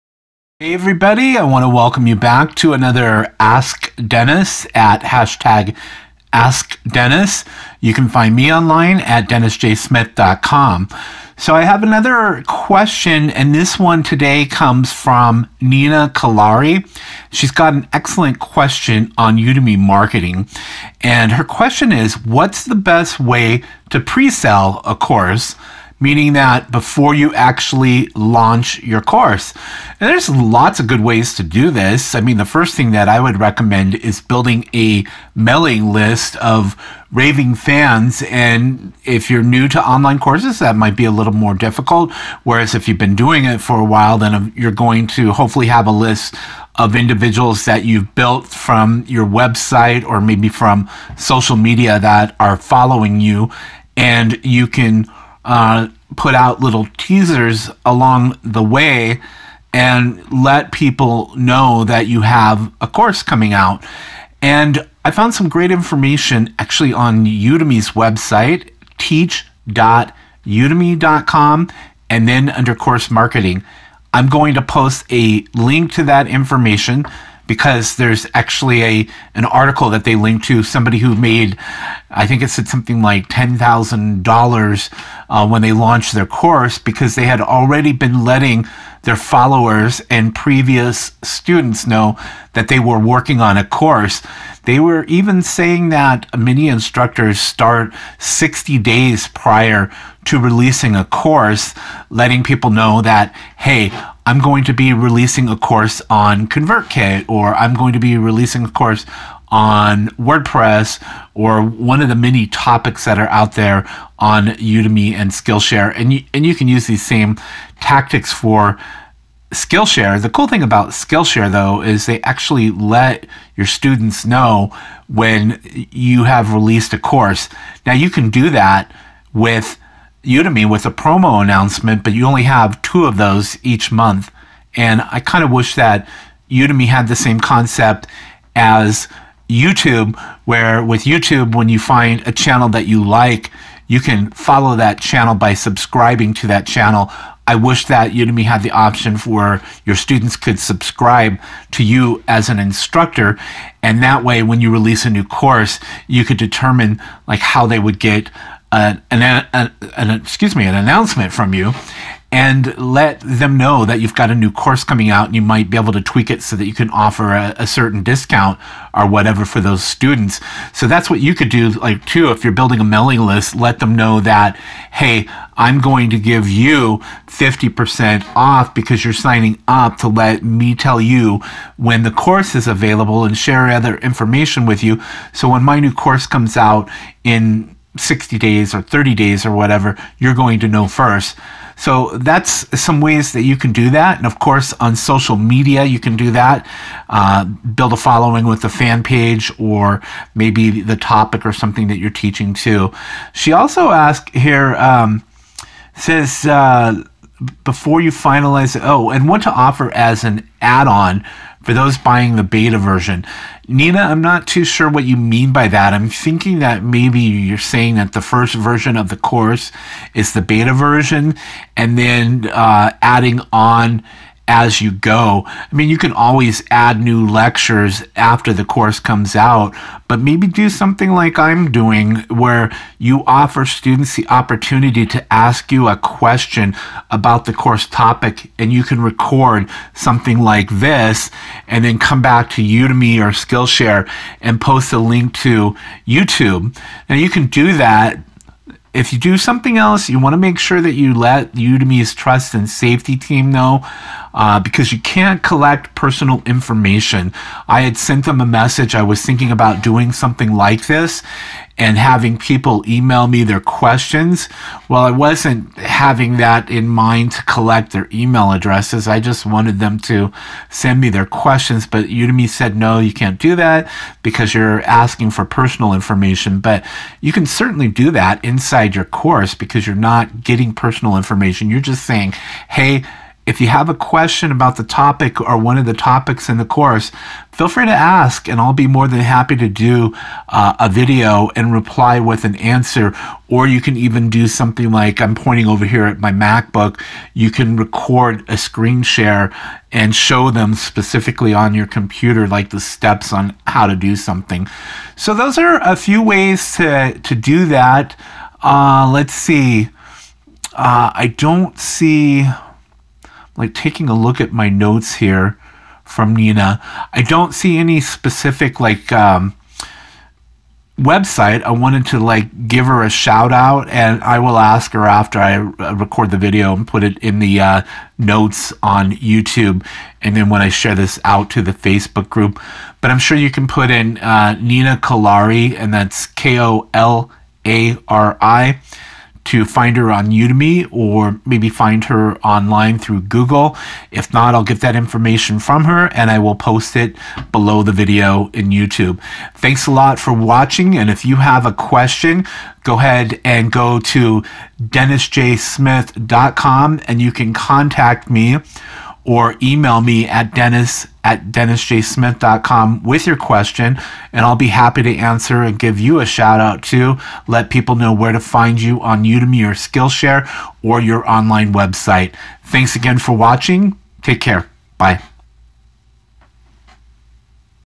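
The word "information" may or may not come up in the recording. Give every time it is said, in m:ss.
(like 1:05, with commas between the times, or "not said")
1:05, 1:16, 3:03, 4:16, 4:35, 4:41, 5:44.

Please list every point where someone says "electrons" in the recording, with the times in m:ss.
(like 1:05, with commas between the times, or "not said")
not said.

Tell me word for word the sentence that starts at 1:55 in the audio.
And you, and you can use these same tactics for Skillshare.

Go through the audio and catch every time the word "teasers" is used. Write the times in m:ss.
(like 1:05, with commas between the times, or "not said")
0:56.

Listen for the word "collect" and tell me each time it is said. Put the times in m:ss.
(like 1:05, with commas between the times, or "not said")
4:15, 4:27.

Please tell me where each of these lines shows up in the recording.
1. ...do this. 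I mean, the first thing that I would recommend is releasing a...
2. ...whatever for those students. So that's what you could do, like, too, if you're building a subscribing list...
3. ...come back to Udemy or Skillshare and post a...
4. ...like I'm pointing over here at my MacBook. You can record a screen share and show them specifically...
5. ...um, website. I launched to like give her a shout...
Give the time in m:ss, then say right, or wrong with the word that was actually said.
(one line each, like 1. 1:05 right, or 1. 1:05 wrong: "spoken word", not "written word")
1. 0:31 wrong: "building", not "releasing"
2. 2:49 wrong: "mailing", not "subscribing"
3. 4:01 right
4. 4:54 right
5. 5:19 wrong: "wanted", not "launched".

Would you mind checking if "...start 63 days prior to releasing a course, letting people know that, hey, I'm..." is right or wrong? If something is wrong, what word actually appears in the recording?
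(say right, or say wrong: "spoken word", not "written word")
wrong: "60", not "63".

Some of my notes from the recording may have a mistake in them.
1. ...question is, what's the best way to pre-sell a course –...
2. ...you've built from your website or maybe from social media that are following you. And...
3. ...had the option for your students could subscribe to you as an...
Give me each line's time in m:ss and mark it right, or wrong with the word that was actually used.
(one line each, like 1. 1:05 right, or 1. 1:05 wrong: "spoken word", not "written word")
1. 0:21 right
2. 0:47 right
3. 2:28 right.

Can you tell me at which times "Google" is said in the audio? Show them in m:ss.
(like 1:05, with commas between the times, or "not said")
5:43.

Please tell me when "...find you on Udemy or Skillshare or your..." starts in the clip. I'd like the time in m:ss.
6:08.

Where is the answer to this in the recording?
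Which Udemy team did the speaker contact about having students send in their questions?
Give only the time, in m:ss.
4:12.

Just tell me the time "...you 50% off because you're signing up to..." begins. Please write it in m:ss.
2:56.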